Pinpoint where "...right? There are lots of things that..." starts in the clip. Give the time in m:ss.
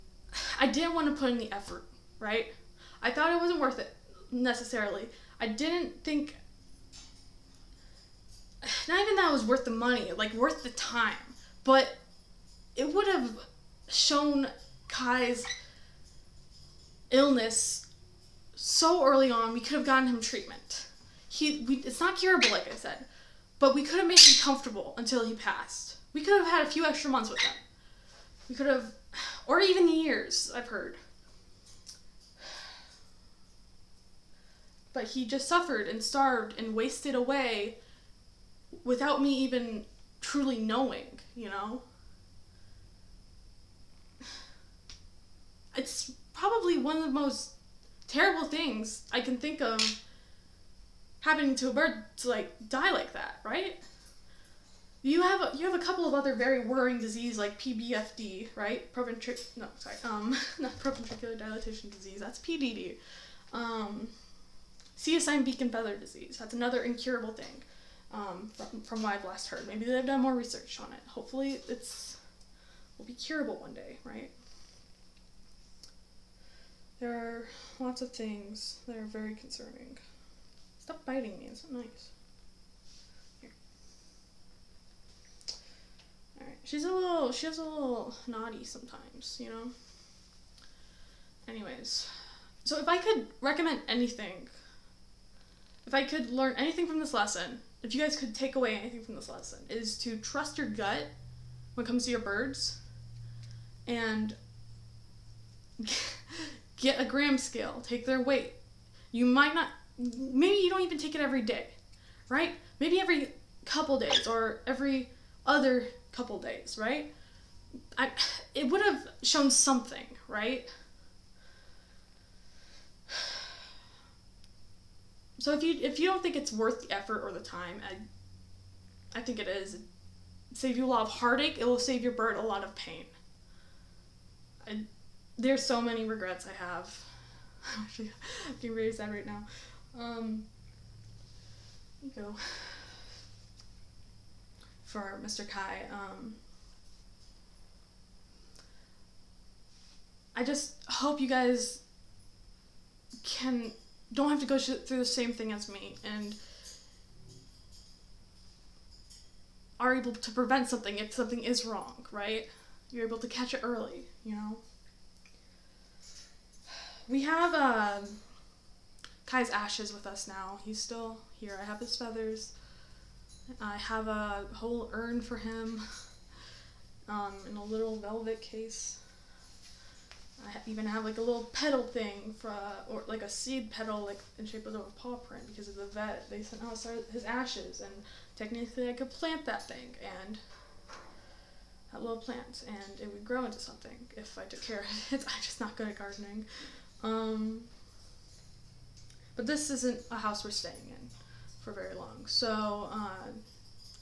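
1:14.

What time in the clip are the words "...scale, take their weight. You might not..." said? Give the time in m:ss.
1:47.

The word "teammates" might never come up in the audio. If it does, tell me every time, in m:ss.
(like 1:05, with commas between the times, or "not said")
not said.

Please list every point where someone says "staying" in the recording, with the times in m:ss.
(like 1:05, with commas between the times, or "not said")
3:20.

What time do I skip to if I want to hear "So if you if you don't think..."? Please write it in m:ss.
2:05.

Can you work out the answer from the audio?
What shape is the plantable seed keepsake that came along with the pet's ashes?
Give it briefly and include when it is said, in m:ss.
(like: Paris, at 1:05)
paw print, at 3:04.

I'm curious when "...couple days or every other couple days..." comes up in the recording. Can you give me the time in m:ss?
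1:53.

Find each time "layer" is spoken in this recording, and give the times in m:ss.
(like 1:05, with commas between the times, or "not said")
not said.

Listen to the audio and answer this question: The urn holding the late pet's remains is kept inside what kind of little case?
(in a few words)
velvet case.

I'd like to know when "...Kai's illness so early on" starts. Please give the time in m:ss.
0:14.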